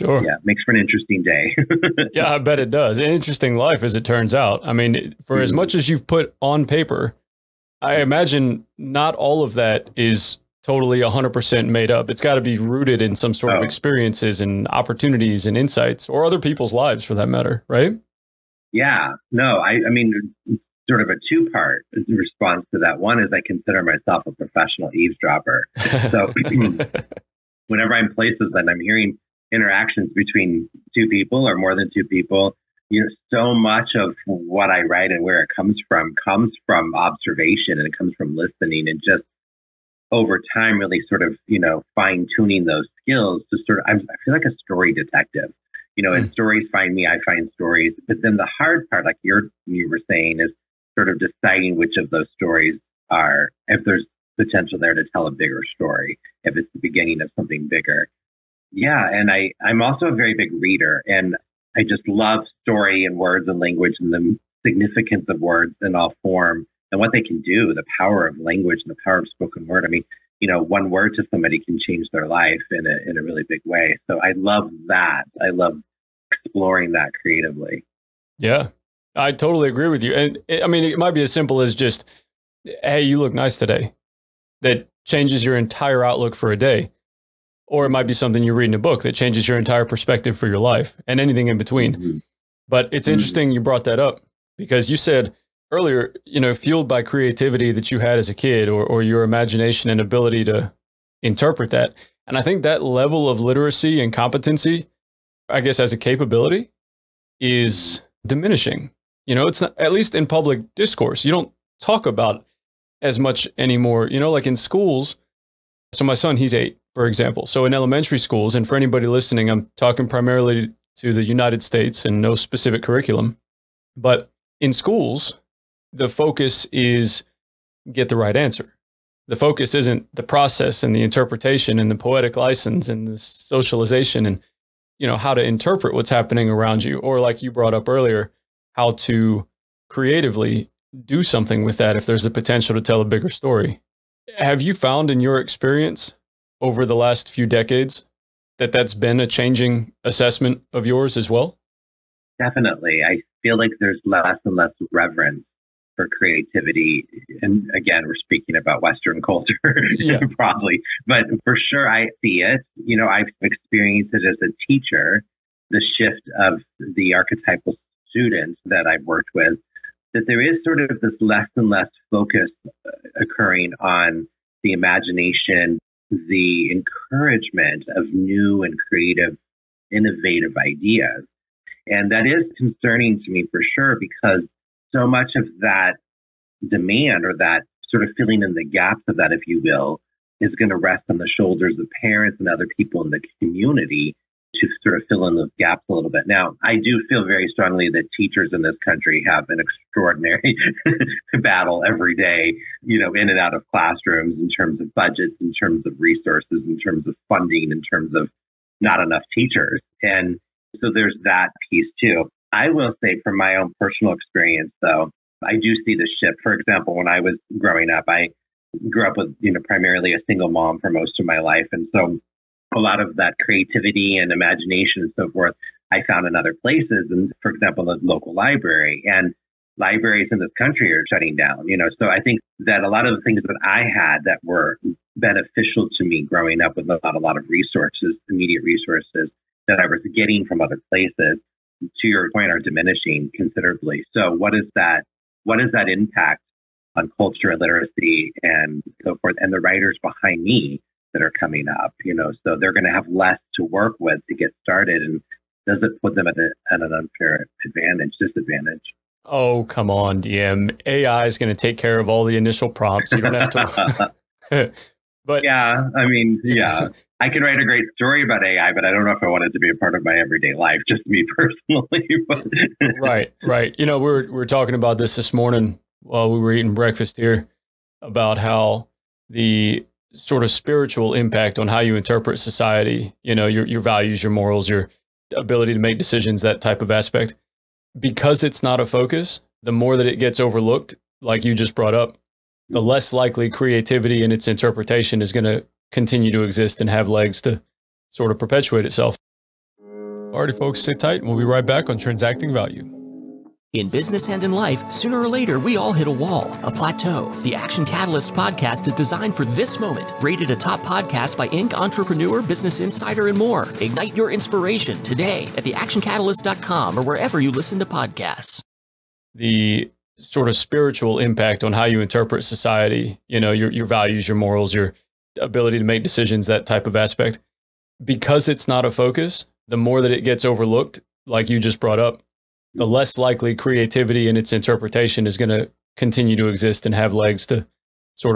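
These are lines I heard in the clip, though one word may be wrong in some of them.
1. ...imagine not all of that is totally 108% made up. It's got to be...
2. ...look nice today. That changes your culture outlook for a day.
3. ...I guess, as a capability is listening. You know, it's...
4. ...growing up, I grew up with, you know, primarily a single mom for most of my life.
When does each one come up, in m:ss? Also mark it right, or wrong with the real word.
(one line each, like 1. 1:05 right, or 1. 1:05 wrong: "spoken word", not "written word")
1. 0:08 wrong: "100", not "108"
2. 1:23 wrong: "entire", not "culture"
3. 1:45 wrong: "diminishing", not "listening"
4. 3:37 right.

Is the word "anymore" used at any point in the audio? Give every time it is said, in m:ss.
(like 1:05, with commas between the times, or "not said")
1:53.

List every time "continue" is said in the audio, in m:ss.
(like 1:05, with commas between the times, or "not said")
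4:55, 5:35.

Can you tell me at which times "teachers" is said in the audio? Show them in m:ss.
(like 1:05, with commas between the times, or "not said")
2:44, 3:18, 3:29.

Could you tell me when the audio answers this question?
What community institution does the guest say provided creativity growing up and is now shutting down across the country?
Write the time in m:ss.
3:48.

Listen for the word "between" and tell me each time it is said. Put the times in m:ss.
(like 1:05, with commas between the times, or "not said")
0:30, 1:31.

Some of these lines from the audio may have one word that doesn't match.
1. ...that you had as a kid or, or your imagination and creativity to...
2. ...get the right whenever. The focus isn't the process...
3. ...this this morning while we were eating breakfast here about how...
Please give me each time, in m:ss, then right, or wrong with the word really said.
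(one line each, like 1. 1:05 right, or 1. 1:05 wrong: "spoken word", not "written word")
1. 1:37 wrong: "ability", not "creativity"
2. 2:07 wrong: "answer", not "whenever"
3. 4:34 right.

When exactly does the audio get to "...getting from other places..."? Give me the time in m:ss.
4:00.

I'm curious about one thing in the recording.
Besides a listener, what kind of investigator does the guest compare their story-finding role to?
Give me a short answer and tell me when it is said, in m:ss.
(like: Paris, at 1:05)
Story detective, at 0:44.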